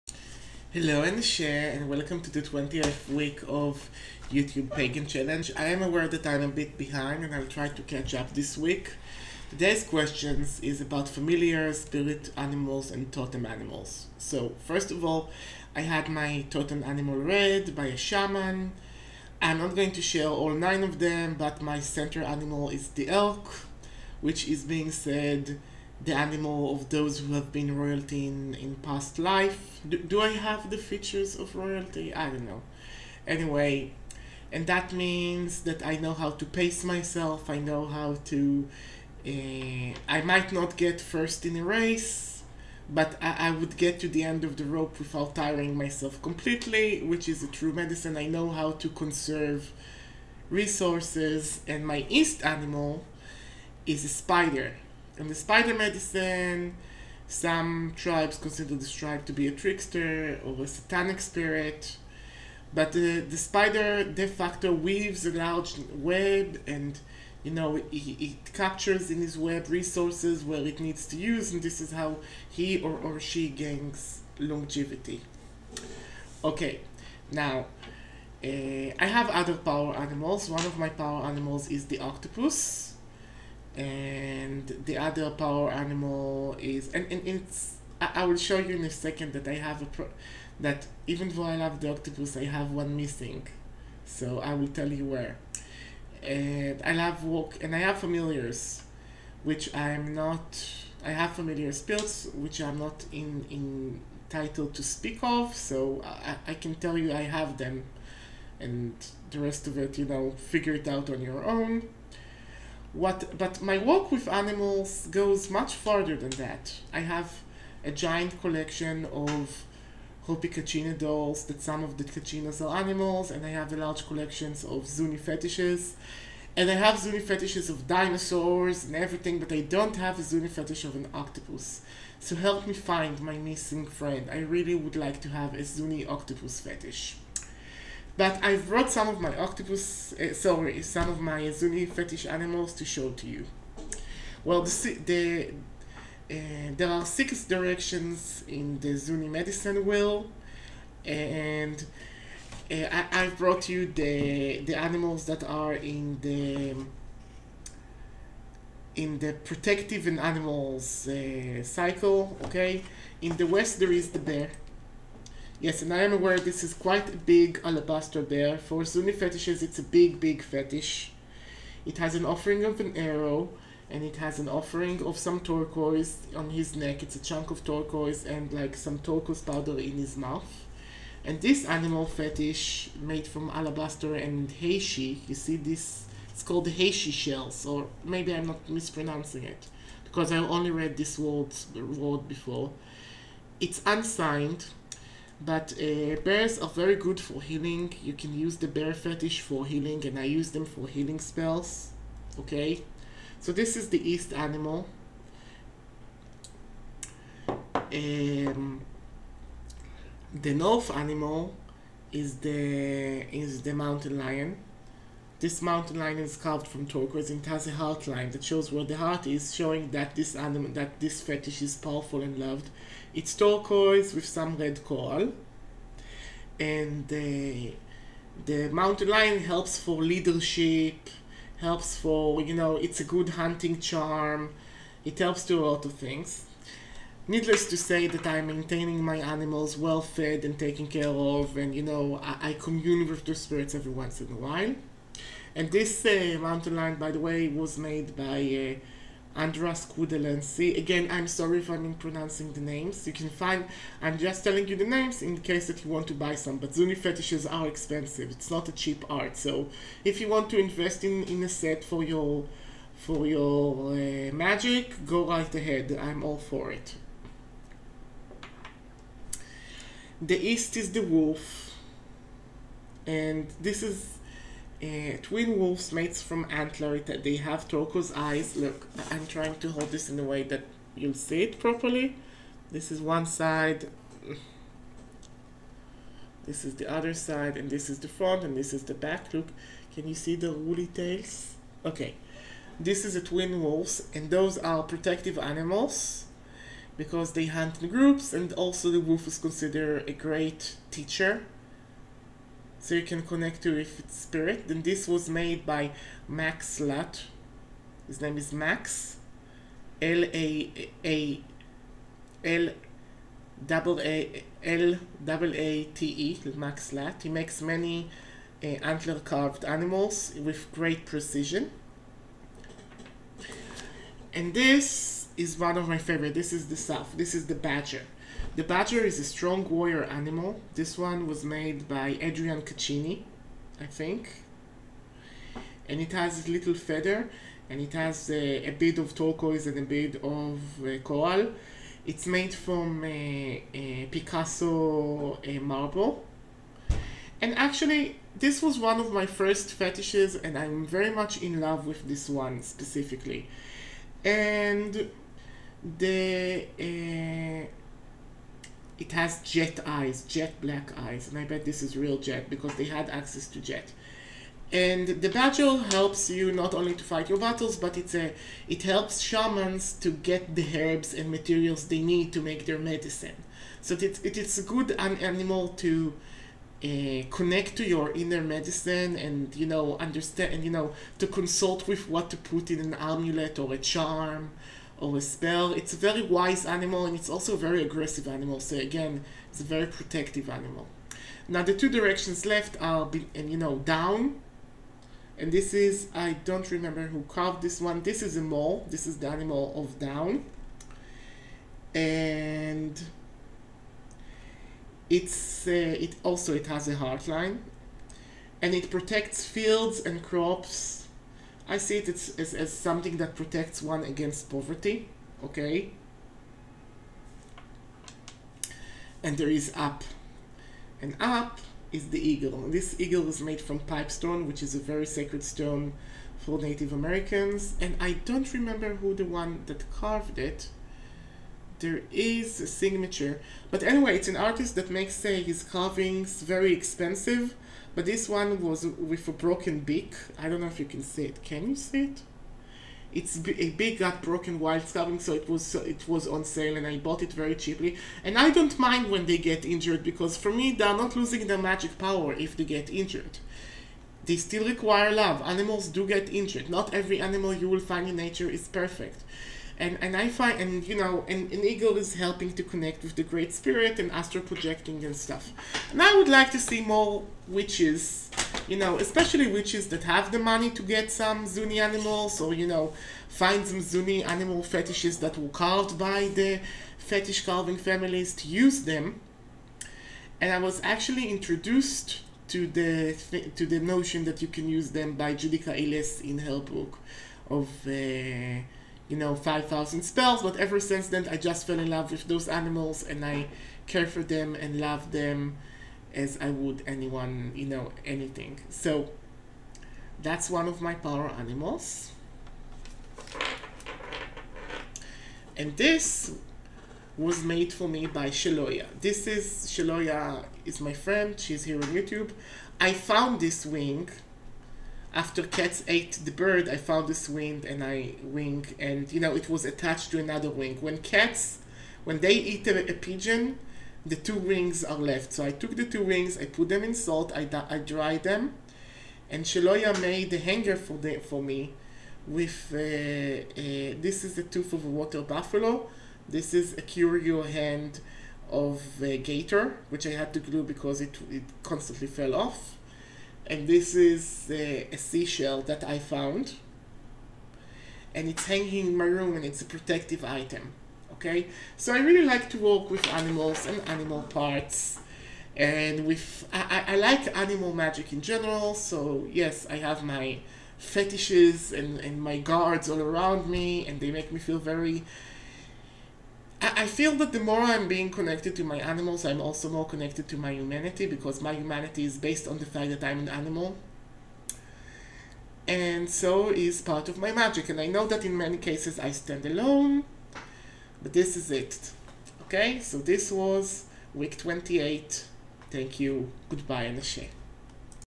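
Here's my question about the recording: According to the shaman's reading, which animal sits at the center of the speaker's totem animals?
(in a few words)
Elk.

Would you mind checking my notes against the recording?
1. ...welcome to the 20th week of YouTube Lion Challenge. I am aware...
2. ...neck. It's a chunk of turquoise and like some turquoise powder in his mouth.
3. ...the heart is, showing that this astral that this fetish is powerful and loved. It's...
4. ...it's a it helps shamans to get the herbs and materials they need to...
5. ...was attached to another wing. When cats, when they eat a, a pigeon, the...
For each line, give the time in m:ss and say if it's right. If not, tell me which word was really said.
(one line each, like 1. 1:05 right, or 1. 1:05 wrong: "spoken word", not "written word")
1. 0:01 wrong: "Pagan", not "Lion"
2. 2:56 right
3. 3:38 wrong: "animal", not "astral"
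4. 6:07 right
5. 8:39 right.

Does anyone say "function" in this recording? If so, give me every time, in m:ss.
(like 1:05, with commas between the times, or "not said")
not said.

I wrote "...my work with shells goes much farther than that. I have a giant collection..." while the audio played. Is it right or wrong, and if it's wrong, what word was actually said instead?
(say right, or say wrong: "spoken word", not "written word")
wrong: "animals", not "shells".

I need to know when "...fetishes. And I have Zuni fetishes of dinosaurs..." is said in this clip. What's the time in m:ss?
2:05.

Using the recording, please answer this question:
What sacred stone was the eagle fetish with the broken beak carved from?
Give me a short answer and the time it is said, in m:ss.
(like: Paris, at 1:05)
Pipestone, at 7:03.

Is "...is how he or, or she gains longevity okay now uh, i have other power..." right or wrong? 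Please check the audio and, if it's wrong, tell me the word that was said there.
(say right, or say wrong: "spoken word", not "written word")
right.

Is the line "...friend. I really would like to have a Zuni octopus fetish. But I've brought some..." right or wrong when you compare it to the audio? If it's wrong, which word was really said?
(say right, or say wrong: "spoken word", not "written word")
right.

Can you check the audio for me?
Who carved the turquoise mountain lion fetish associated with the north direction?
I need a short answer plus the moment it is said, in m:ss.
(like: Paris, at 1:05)
Andres Quandelacy, at 4:09.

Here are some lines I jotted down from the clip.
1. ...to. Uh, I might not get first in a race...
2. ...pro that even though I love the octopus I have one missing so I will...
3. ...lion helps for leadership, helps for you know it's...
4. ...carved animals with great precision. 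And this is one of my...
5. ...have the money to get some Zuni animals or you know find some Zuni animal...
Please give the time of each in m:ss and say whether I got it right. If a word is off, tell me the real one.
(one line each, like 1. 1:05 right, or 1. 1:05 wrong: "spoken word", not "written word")
1. 0:38 right
2. 1:29 right
3. 3:49 right
4. 5:19 right
5. 7:50 right.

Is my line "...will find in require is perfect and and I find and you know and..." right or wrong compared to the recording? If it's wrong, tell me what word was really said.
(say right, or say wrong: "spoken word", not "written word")
wrong: "nature", not "require".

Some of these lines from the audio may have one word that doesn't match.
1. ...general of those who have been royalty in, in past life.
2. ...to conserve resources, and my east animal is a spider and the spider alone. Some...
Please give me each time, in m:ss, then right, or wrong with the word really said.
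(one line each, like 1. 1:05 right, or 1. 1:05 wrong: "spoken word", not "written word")
1. 0:26 wrong: "animal", not "general"
2. 0:48 wrong: "medicine", not "alone".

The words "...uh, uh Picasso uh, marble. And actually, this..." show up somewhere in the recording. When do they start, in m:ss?
5:43.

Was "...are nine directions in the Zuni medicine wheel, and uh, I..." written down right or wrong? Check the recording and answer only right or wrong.
wrong.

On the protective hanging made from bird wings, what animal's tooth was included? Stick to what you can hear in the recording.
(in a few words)
Water buffalo.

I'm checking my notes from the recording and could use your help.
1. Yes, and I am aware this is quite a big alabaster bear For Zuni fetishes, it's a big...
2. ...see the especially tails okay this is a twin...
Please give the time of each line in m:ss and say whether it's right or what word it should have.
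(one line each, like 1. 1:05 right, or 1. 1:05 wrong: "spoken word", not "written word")
1. 2:45 right
2. 4:50 wrong: "woolly", not "especially".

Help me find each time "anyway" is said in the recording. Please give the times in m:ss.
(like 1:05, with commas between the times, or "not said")
0:33, 7:13.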